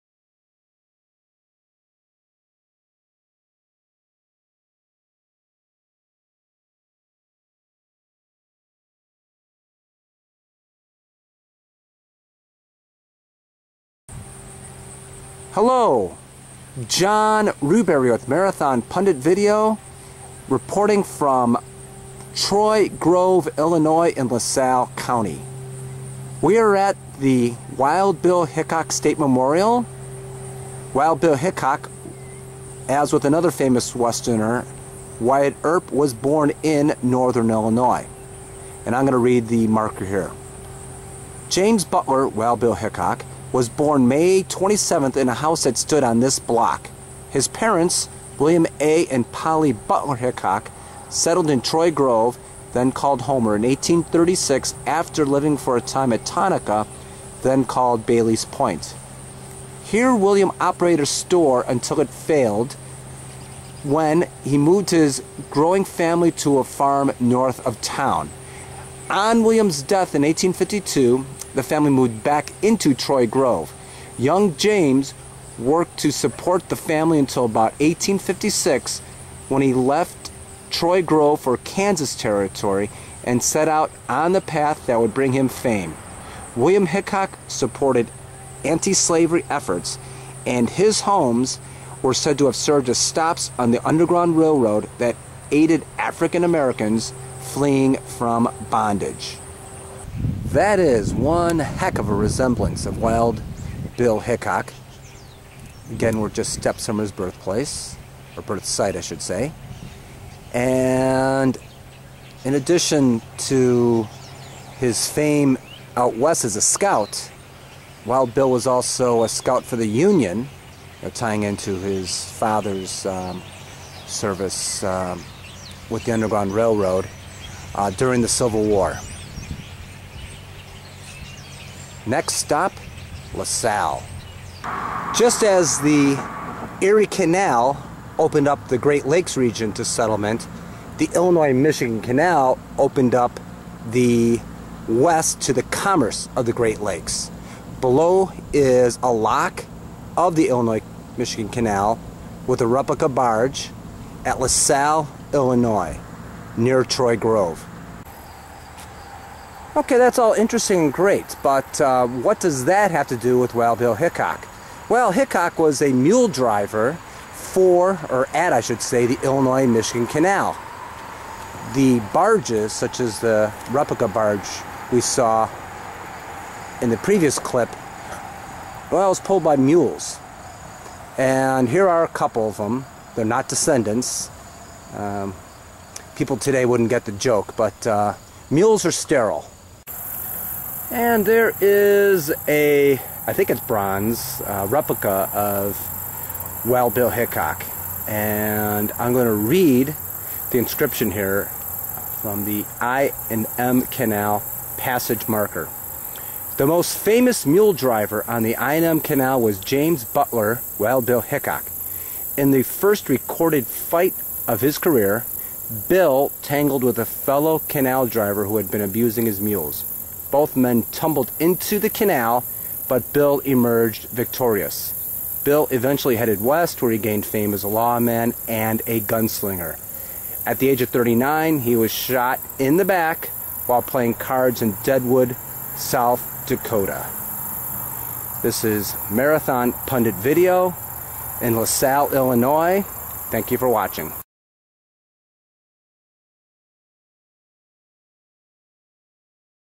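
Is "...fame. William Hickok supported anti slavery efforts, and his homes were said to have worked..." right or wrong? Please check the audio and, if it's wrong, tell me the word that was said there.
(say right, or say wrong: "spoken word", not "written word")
wrong: "served", not "worked".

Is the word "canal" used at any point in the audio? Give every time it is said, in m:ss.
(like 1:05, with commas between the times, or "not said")
2:17, 2:22, 2:31, 2:50, 3:23, 3:28, 3:37, 3:41.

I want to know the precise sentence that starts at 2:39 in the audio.
Okay, that's all interesting and great, but uh, what does that have to do with Wild Bill Hickok?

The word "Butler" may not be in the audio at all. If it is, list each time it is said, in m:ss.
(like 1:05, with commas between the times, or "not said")
0:41, 0:49, 3:30.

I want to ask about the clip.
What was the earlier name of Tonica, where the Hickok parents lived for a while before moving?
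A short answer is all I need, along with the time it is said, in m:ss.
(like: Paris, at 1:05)
Bailey's Point, at 0:58.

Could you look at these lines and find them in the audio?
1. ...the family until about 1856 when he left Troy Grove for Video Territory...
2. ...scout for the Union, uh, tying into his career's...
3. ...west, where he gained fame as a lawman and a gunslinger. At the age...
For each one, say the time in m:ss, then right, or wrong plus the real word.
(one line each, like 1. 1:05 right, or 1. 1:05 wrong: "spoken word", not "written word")
1. 1:16 wrong: "Kansas", not "Video"
2. 1:59 wrong: "father", not "career"
3. 3:46 right.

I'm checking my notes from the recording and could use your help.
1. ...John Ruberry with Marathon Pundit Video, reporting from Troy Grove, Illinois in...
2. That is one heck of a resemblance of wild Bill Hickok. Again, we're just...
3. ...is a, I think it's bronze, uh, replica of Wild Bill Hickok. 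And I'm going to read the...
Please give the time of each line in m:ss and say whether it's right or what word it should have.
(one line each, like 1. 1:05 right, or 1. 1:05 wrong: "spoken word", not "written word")
1. 0:16 right
2. 1:40 right
3. 3:11 right.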